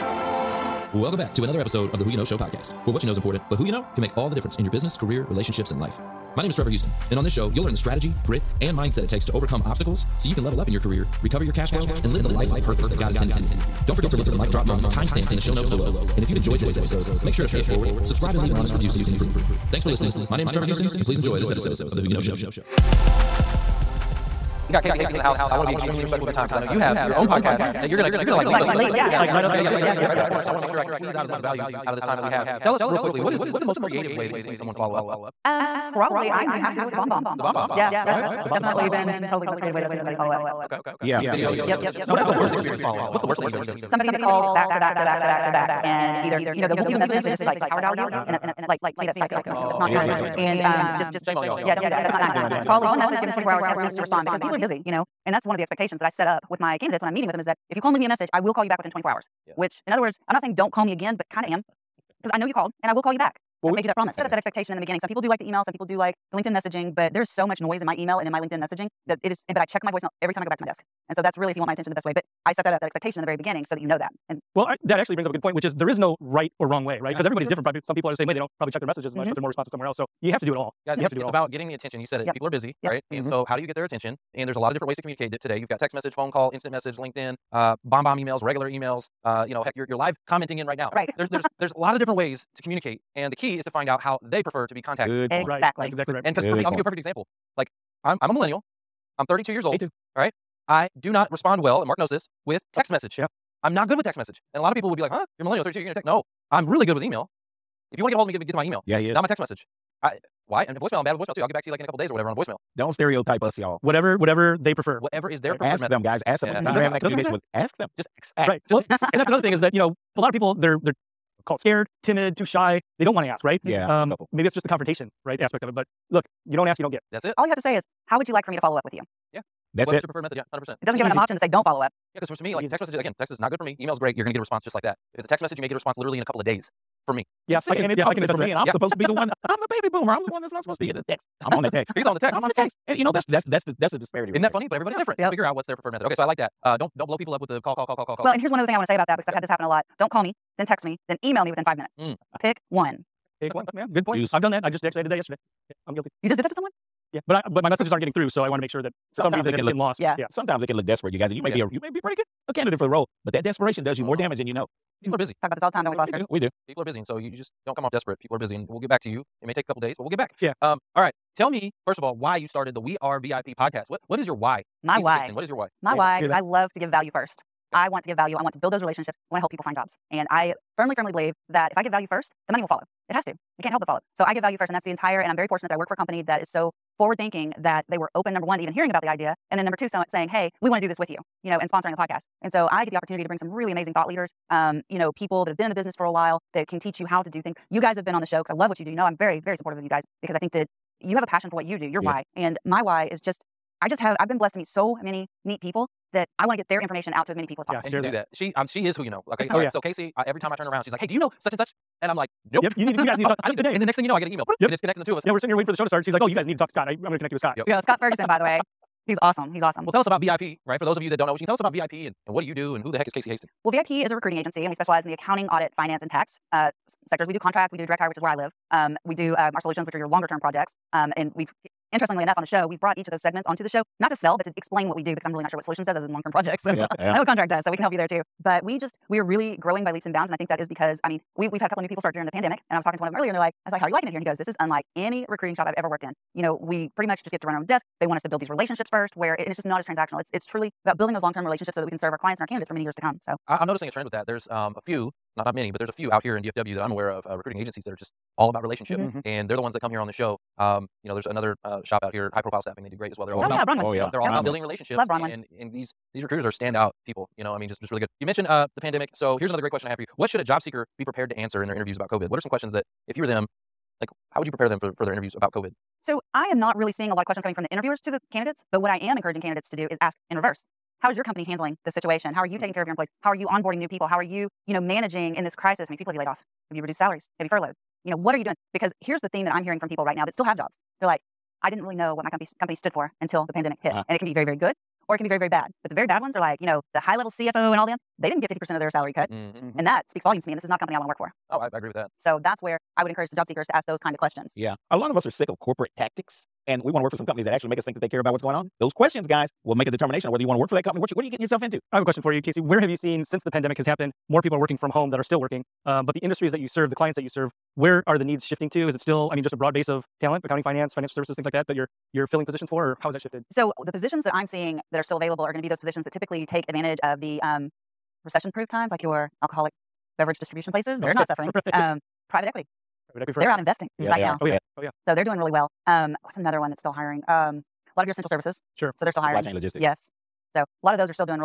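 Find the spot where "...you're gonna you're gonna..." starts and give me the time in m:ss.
0:27.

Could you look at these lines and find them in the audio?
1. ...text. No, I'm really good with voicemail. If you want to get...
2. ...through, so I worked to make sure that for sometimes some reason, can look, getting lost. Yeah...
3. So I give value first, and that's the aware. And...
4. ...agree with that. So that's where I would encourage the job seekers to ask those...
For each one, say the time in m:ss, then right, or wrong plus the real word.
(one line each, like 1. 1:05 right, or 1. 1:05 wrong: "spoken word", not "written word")
1. 1:45 wrong: "email", not "voicemail"
2. 2:38 wrong: "wanted", not "worked"
3. 3:04 wrong: "entire", not "aware"
4. 5:01 right.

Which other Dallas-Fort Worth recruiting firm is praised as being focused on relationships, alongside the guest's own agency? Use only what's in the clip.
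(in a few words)
High Profile Staffing.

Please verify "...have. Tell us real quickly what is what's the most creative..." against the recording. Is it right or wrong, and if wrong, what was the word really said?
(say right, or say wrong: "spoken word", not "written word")
right.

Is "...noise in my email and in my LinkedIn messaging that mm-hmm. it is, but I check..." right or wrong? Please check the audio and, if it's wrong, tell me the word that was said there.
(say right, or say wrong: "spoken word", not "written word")
right.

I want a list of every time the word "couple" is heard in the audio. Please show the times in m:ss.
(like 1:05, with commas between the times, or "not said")
1:51, 2:04, 2:16, 2:49, 4:01.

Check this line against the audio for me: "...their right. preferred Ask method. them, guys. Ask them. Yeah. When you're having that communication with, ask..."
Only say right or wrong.
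right.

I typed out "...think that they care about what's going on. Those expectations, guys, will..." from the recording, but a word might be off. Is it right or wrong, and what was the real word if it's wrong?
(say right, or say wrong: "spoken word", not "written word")
wrong: "questions", not "expectations".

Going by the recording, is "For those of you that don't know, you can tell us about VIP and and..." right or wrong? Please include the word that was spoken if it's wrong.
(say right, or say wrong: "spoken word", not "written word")
right.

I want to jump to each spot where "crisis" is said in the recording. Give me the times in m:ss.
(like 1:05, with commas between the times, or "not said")
4:45.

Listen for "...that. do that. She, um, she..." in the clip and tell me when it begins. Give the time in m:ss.
3:28.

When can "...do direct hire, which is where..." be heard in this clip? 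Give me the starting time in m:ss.
3:47.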